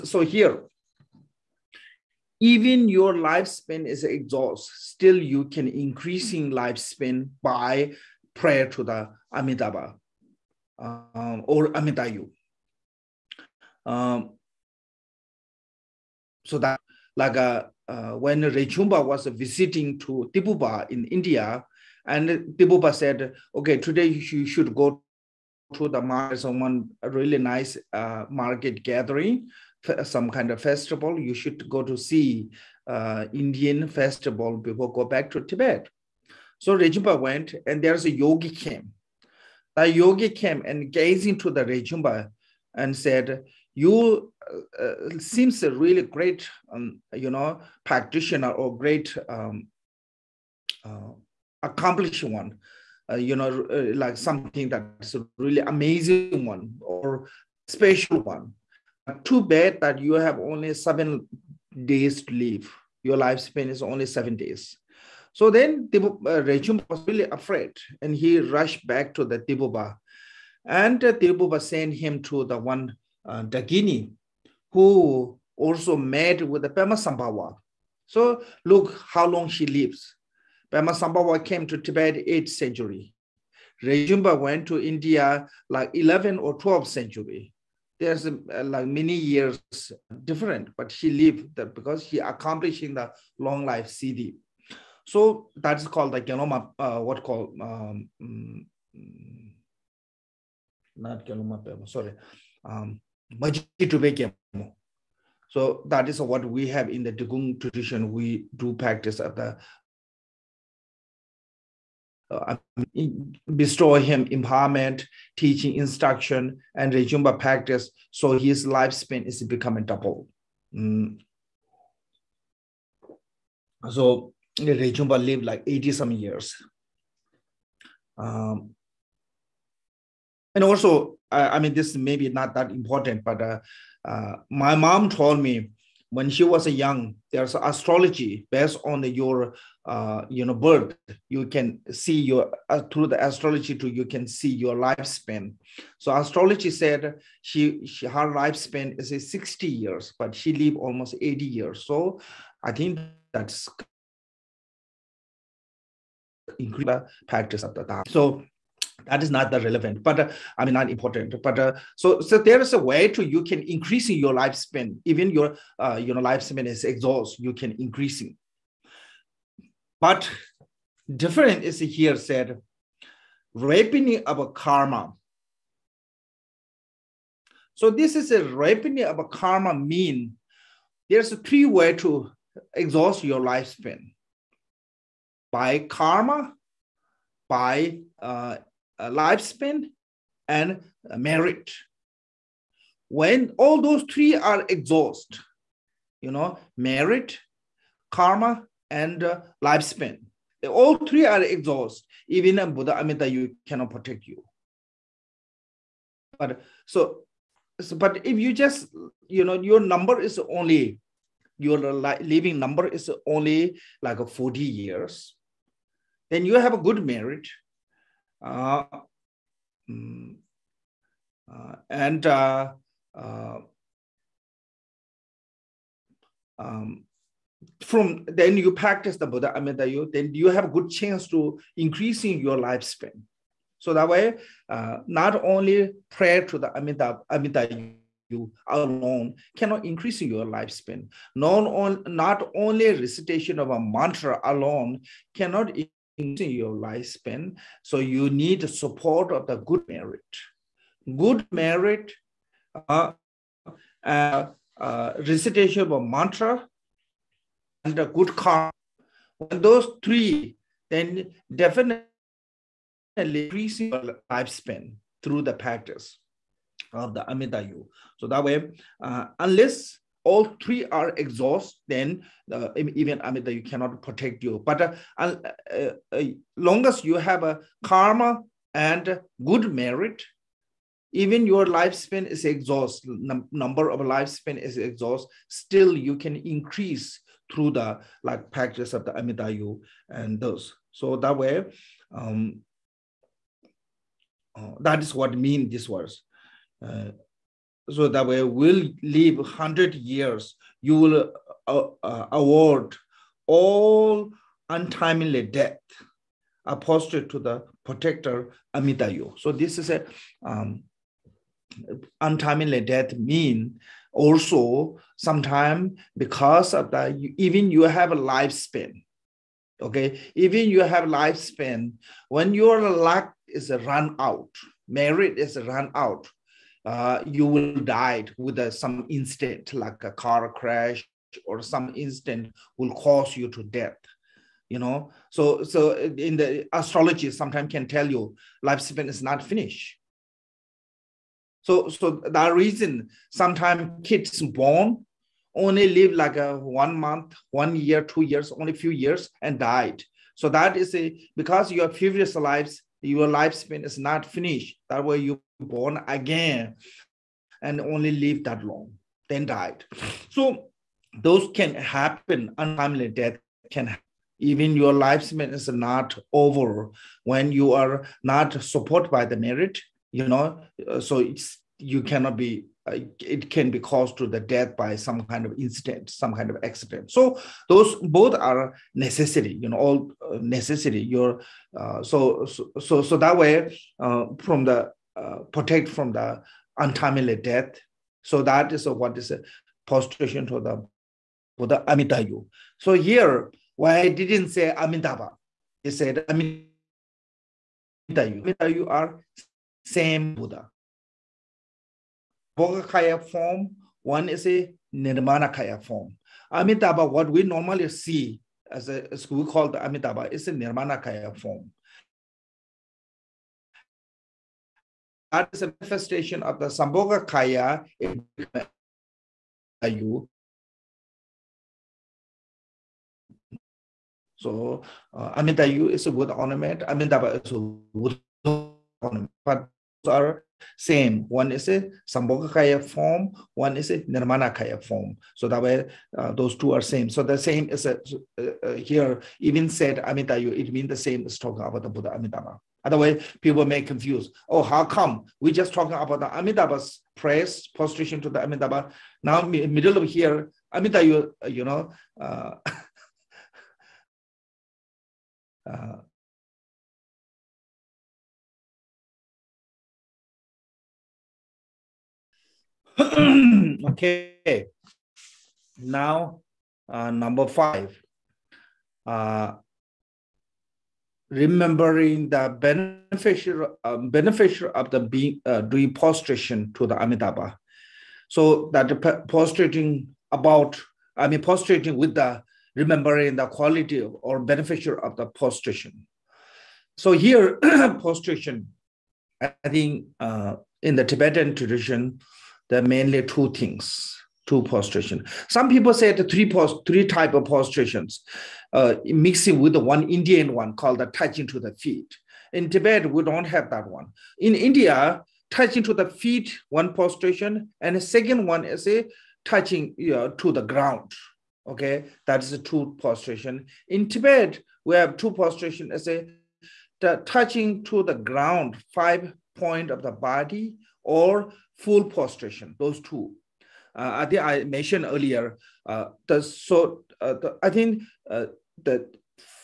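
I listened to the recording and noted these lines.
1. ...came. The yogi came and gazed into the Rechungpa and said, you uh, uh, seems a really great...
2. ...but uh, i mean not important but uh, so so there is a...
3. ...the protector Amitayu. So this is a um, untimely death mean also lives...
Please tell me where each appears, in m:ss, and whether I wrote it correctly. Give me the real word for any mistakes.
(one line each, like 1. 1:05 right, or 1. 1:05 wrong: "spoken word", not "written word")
1. 0:38 right
2. 2:40 right
3. 5:07 wrong: "sometimes", not "lives".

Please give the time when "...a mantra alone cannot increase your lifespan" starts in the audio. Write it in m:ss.
4:03.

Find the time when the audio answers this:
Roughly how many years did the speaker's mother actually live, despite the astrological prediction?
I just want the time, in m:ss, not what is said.
2:30.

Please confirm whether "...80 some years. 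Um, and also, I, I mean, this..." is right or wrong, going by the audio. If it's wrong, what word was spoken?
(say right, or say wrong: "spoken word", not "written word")
right.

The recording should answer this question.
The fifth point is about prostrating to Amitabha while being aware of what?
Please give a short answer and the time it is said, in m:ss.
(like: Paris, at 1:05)
beneficial of the prostration, at 8:04.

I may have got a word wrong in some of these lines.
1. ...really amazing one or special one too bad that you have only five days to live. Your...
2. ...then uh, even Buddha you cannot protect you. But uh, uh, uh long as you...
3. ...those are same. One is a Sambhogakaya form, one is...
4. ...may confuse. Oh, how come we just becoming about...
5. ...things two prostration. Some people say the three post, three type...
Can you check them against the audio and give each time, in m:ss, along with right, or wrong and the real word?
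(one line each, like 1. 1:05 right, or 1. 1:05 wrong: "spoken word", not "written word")
1. 0:55 wrong: "seven", not "five"
2. 4:31 wrong: "Amida", not "Buddha"
3. 7:10 right
4. 7:23 wrong: "talking", not "becoming"
5. 8:13 right.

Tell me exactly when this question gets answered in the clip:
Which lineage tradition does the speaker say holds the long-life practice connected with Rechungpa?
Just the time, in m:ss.
1:47.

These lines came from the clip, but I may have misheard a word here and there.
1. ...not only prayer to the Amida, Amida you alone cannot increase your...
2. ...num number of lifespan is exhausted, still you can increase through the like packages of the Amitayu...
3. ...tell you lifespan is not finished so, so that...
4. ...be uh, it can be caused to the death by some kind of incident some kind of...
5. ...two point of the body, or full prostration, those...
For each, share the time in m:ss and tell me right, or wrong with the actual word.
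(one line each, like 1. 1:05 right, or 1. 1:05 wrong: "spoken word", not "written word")
1. 3:55 right
2. 4:43 right
3. 5:37 right
4. 6:12 right
5. 8:38 wrong: "five", not "two".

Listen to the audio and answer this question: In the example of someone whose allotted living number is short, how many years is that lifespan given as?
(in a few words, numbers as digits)
40 years.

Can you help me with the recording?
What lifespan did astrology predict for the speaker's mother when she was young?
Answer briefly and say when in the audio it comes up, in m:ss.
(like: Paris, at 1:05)
60 years, at 2:29.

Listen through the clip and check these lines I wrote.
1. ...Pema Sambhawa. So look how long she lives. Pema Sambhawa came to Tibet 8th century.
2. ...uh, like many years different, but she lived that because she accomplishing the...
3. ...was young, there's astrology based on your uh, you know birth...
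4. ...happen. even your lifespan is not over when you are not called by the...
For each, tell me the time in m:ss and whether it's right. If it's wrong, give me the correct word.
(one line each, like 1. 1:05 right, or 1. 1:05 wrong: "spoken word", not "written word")
1. 1:16 right
2. 1:28 right
3. 2:16 right
4. 6:03 wrong: "supported", not "called".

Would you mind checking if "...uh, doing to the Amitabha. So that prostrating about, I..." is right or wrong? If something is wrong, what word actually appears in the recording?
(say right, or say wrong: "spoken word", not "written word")
right.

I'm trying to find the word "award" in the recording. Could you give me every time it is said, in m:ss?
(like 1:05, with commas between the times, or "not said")
5:02.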